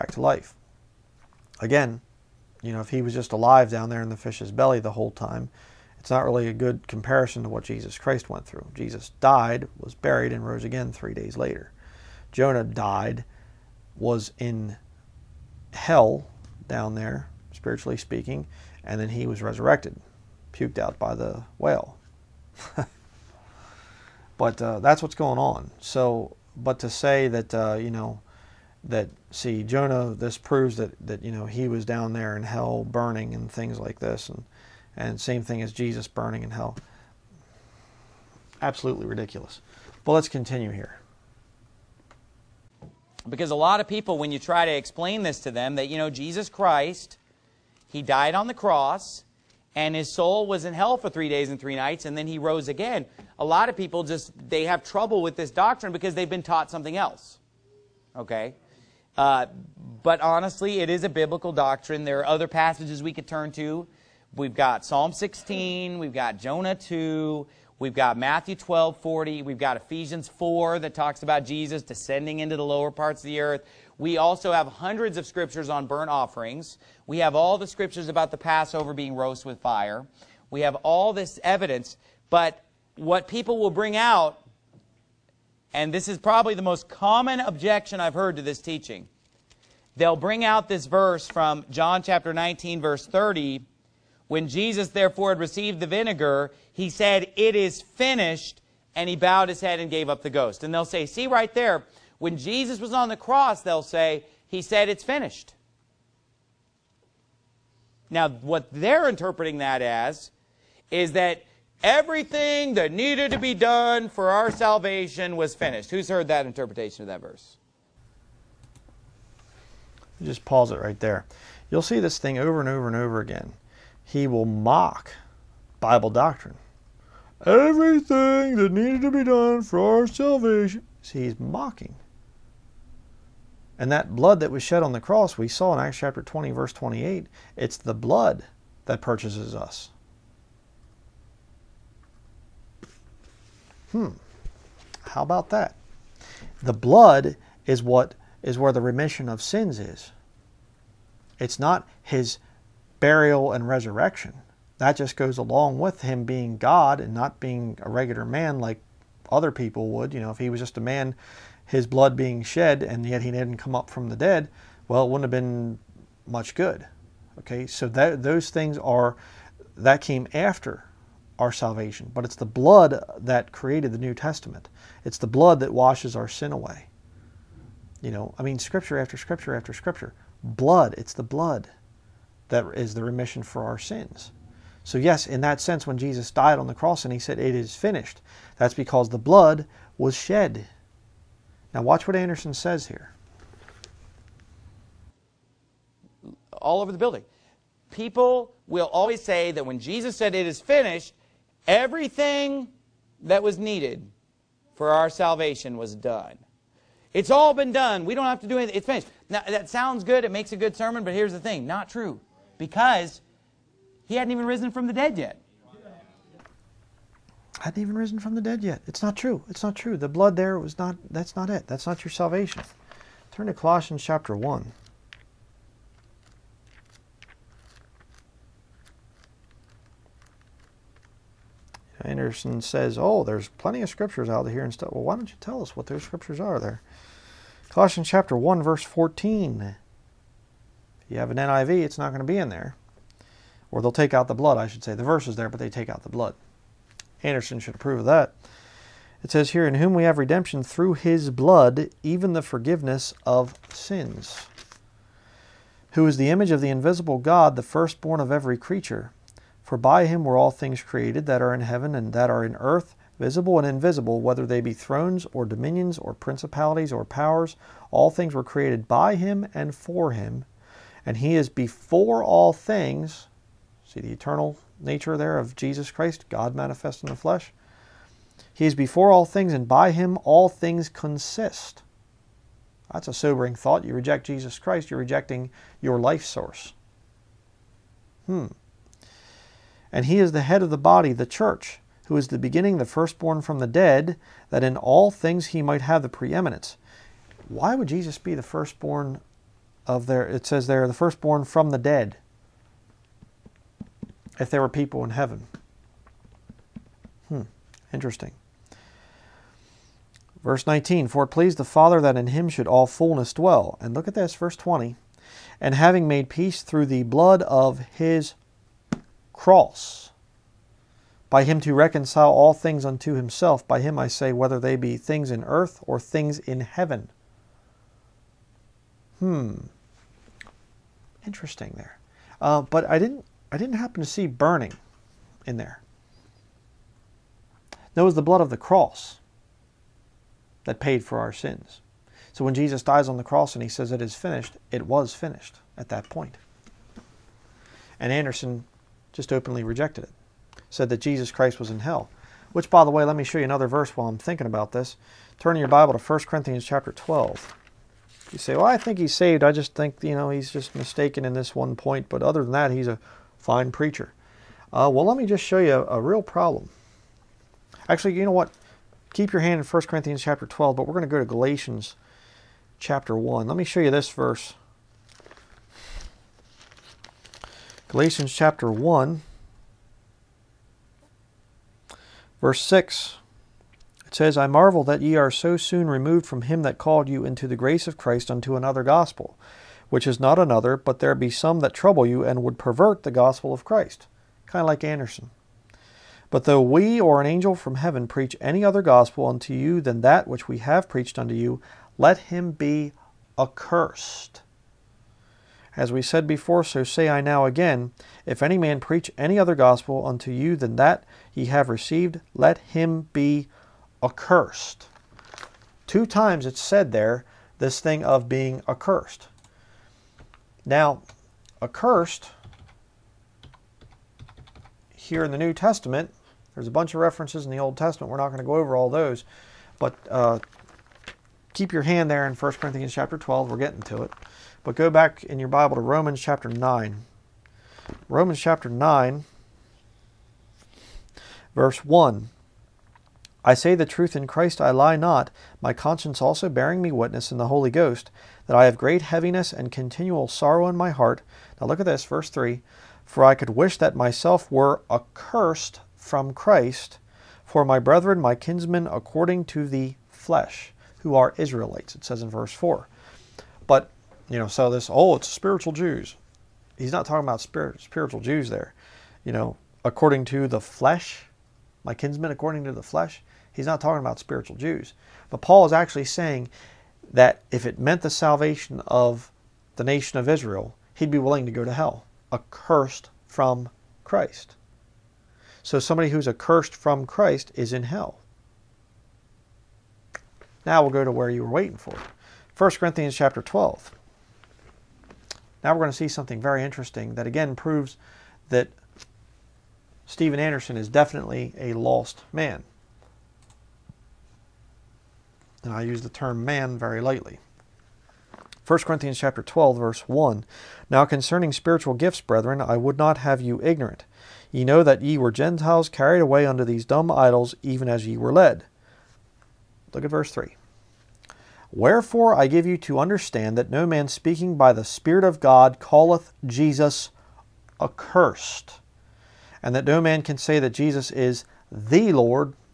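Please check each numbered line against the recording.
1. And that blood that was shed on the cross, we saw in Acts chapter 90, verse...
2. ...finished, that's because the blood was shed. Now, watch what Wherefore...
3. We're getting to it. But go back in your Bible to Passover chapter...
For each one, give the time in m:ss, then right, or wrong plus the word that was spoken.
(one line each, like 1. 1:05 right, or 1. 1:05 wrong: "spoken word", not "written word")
1. 2:13 wrong: "20", not "90"
2. 3:07 wrong: "Anderson", not "Wherefore"
3. 7:13 wrong: "Romans", not "Passover".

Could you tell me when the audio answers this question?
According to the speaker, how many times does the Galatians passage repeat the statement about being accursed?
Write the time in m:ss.
6:55.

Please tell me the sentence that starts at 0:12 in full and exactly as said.
Jonah died, was in hell down there, spiritually speaking, and then he was resurrected, puked out by the whale.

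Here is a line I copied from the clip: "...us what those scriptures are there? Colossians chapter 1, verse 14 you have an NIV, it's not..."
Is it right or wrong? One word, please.
right.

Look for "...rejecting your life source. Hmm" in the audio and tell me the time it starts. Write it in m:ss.
4:44.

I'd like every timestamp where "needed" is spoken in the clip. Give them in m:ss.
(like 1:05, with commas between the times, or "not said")
1:52, 2:08, 3:23.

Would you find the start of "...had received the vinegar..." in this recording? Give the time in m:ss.
1:35.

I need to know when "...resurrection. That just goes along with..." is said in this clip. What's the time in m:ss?
2:33.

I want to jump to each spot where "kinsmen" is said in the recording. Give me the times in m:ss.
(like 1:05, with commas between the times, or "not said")
7:38, 7:51.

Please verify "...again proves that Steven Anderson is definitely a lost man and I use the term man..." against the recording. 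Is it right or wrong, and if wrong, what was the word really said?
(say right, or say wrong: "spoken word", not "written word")
right.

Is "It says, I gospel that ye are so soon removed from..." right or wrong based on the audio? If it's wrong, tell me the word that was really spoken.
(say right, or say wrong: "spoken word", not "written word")
wrong: "marvel", not "gospel".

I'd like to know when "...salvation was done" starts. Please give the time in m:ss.
3:25.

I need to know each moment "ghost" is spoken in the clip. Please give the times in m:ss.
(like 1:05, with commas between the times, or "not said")
1:40, 7:27.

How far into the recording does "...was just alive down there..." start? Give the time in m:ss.
0:03.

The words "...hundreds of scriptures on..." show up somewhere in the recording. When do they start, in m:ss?
1:14.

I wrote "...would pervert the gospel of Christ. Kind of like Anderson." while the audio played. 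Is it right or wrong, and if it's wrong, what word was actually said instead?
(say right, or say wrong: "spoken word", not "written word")
right.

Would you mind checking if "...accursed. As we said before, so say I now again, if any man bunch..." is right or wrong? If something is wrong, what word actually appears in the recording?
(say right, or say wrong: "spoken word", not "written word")
wrong: "preach", not "bunch".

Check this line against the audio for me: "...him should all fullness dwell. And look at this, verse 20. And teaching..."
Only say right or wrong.
wrong.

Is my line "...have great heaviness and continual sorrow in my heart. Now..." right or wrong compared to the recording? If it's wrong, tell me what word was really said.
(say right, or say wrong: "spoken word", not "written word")
right.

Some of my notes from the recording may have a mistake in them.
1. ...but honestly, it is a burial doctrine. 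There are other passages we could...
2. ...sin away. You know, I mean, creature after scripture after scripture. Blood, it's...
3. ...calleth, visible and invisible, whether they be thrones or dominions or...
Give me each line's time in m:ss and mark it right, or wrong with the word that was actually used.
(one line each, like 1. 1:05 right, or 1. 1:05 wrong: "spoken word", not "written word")
1. 1:00 wrong: "biblical", not "burial"
2. 2:56 wrong: "scripture", not "creature"
3. 4:22 wrong: "earth", not "calleth".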